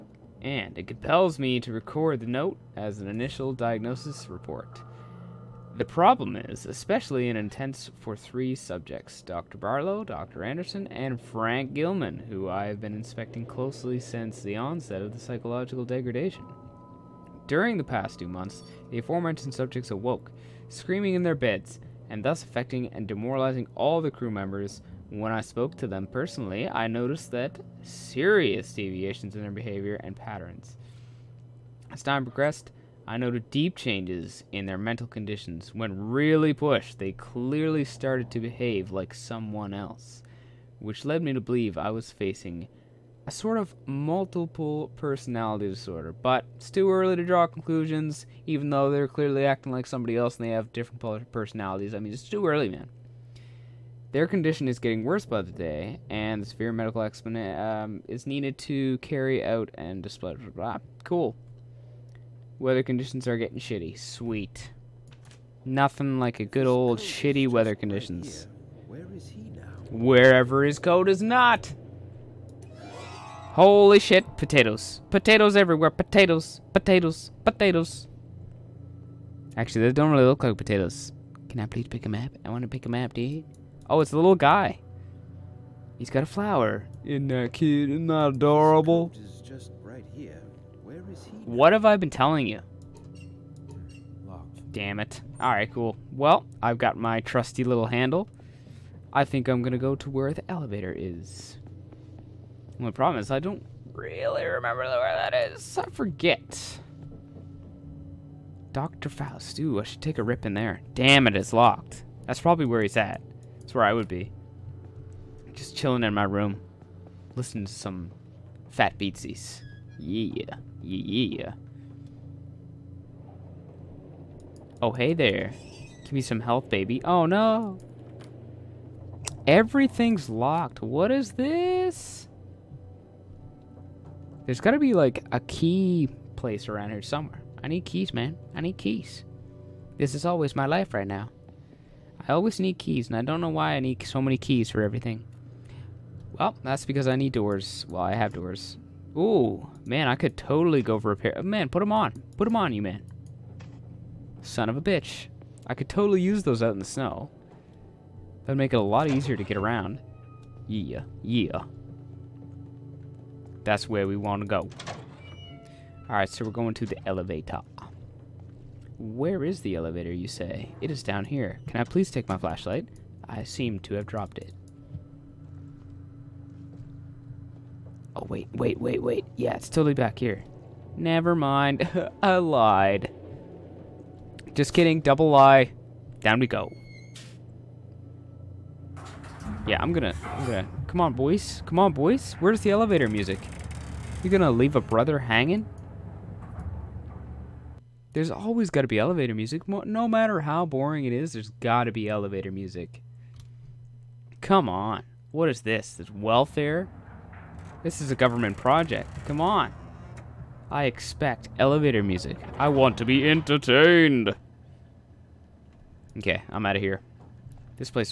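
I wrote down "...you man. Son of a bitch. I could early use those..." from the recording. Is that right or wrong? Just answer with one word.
wrong.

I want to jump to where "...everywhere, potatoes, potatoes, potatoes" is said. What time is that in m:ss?
1:15.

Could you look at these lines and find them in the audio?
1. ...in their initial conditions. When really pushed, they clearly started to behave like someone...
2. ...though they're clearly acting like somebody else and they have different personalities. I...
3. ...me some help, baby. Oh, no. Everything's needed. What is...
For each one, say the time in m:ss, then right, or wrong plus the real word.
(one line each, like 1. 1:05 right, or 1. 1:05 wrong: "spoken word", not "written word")
1. 0:34 wrong: "mental", not "initial"
2. 0:48 right
3. 2:06 wrong: "locked", not "needed".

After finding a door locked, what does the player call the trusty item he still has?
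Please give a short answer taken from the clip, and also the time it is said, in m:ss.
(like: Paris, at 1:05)
Handle, at 1:37.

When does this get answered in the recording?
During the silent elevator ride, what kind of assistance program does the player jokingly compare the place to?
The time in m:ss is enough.
3:26.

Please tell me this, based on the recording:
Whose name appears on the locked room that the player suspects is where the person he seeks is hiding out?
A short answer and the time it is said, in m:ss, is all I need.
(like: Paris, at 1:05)
Dr. Faust, at 1:48.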